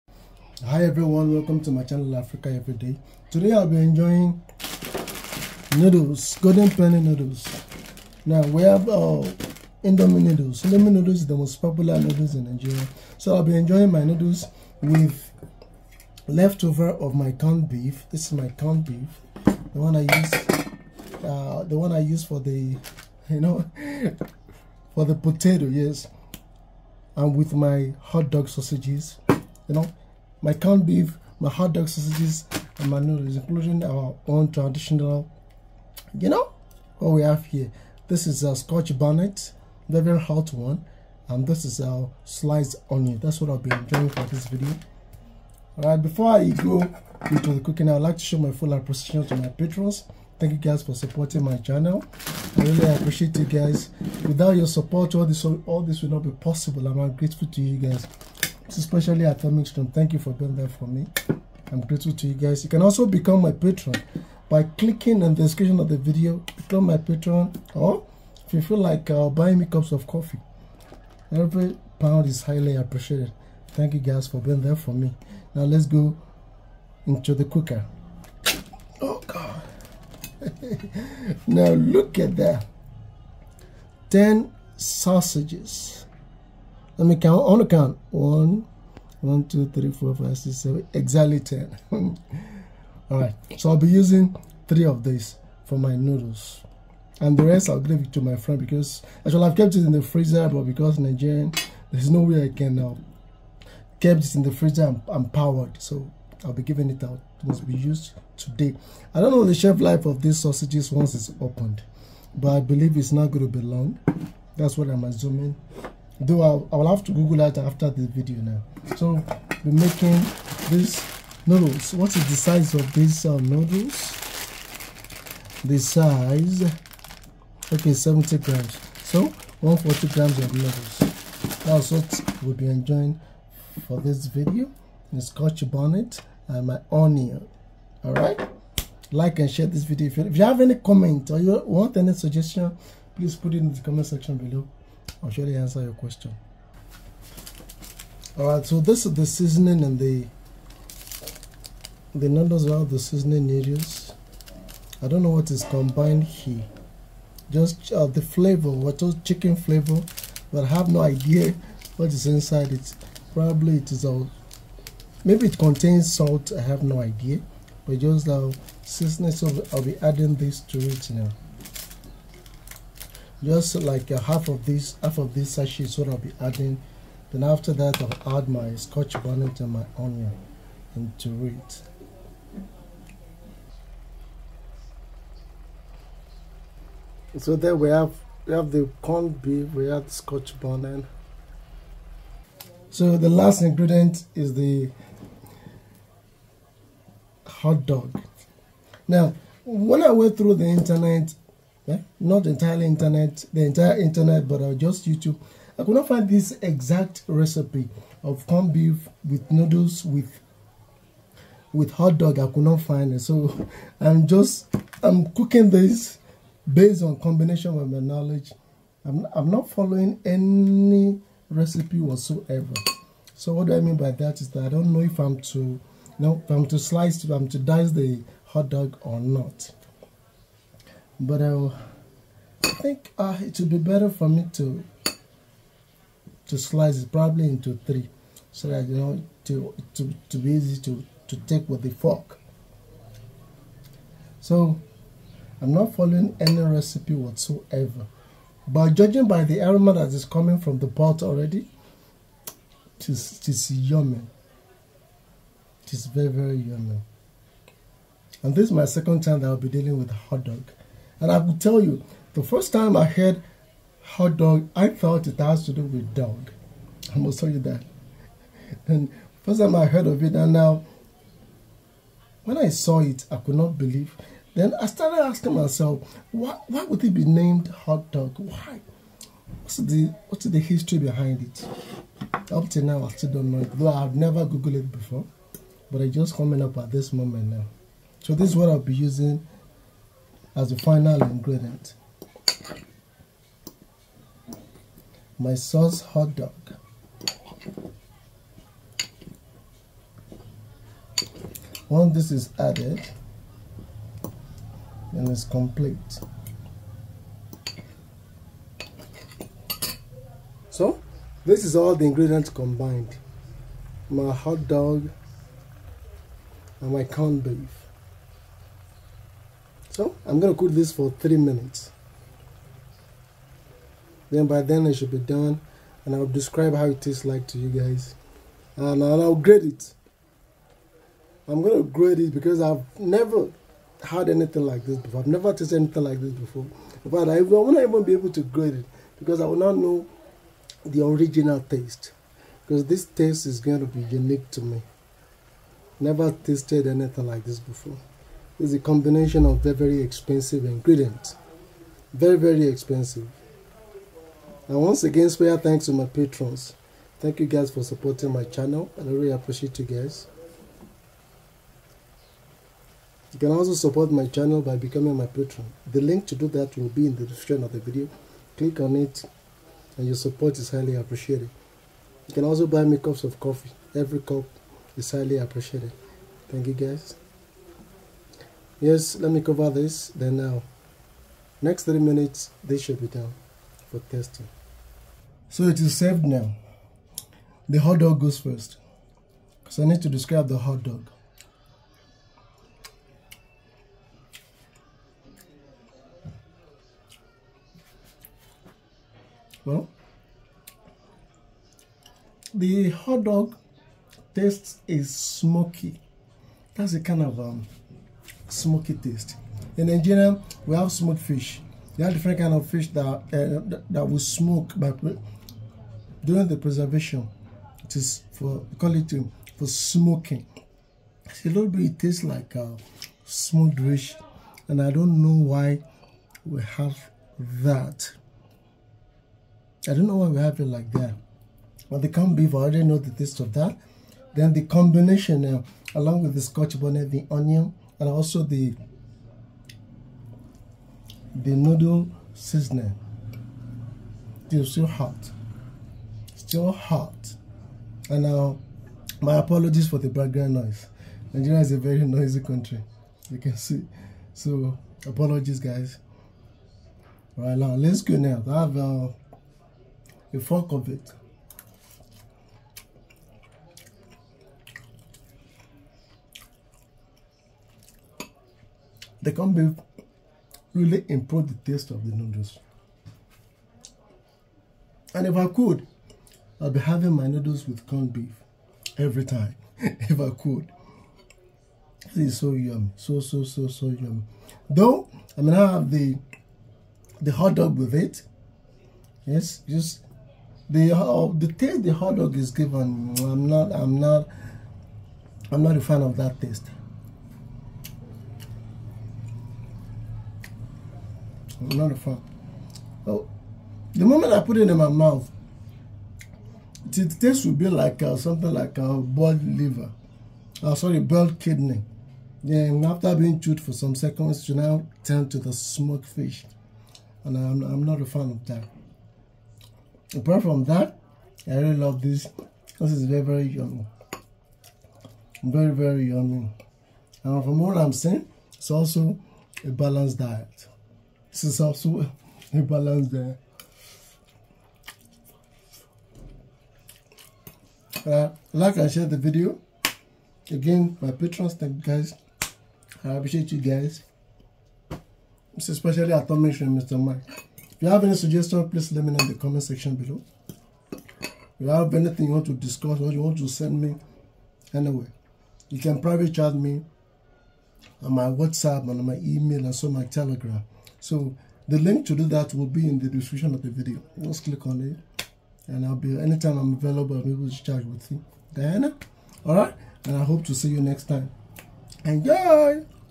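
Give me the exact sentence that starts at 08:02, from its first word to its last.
is so yummy, so, so, so, so yummy.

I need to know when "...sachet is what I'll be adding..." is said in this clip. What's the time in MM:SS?
02:55.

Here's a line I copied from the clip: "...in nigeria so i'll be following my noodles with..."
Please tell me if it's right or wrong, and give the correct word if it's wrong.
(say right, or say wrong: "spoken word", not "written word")
wrong: "enjoying", not "following".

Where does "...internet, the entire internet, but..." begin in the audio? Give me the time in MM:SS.
03:22.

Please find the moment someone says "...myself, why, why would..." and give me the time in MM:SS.
04:35.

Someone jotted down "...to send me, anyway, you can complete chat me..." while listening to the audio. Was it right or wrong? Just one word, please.
wrong.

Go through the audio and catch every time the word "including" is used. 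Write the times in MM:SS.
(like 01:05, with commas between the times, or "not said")
00:33.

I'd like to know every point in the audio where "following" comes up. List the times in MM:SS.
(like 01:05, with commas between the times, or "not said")
03:39, 04:05.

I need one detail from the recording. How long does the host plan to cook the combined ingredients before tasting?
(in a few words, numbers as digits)
3 minutes.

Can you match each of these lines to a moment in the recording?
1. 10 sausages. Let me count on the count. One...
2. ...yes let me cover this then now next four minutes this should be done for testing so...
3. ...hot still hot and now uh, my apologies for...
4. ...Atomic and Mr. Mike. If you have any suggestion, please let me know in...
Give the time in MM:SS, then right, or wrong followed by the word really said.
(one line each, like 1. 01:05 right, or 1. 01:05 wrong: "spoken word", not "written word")
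1. 01:24 right
2. 06:18 wrong: "three", not "four"
3. 07:24 right
4. 09:06 right.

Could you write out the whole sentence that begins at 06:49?
In Nigeria, we have smoked fish.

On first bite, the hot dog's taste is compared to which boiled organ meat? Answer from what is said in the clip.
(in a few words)
Kidney.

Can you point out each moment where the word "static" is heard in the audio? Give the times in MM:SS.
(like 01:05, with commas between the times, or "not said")
not said.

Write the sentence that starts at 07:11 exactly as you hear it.
But the corned beef, I already know the taste of that.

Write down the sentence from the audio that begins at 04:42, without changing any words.
Up till now, I still don't know it.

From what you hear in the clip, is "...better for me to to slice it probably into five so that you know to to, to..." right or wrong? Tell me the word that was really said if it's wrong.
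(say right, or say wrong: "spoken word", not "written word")
wrong: "three", not "five".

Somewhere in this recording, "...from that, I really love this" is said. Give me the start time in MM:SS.
08:40.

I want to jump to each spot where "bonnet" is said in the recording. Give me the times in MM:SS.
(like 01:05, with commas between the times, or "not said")
00:38, 02:15, 02:59, 03:10, 07:16.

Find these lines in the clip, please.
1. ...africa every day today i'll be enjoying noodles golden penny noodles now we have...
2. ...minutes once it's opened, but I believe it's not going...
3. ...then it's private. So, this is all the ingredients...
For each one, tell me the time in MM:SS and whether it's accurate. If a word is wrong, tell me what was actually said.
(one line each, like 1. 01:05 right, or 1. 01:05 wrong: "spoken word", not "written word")
1. 00:02 right
2. 01:50 wrong: "sausages", not "minutes"
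3. 05:05 wrong: "complete", not "private".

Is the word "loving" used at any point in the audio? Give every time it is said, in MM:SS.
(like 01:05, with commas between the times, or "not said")
not said.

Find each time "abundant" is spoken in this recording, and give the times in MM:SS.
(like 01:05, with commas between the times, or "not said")
not said.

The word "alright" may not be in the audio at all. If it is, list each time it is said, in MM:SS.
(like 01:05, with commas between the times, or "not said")
00:45, 09:29.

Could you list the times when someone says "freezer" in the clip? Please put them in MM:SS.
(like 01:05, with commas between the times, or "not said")
01:40, 01:44.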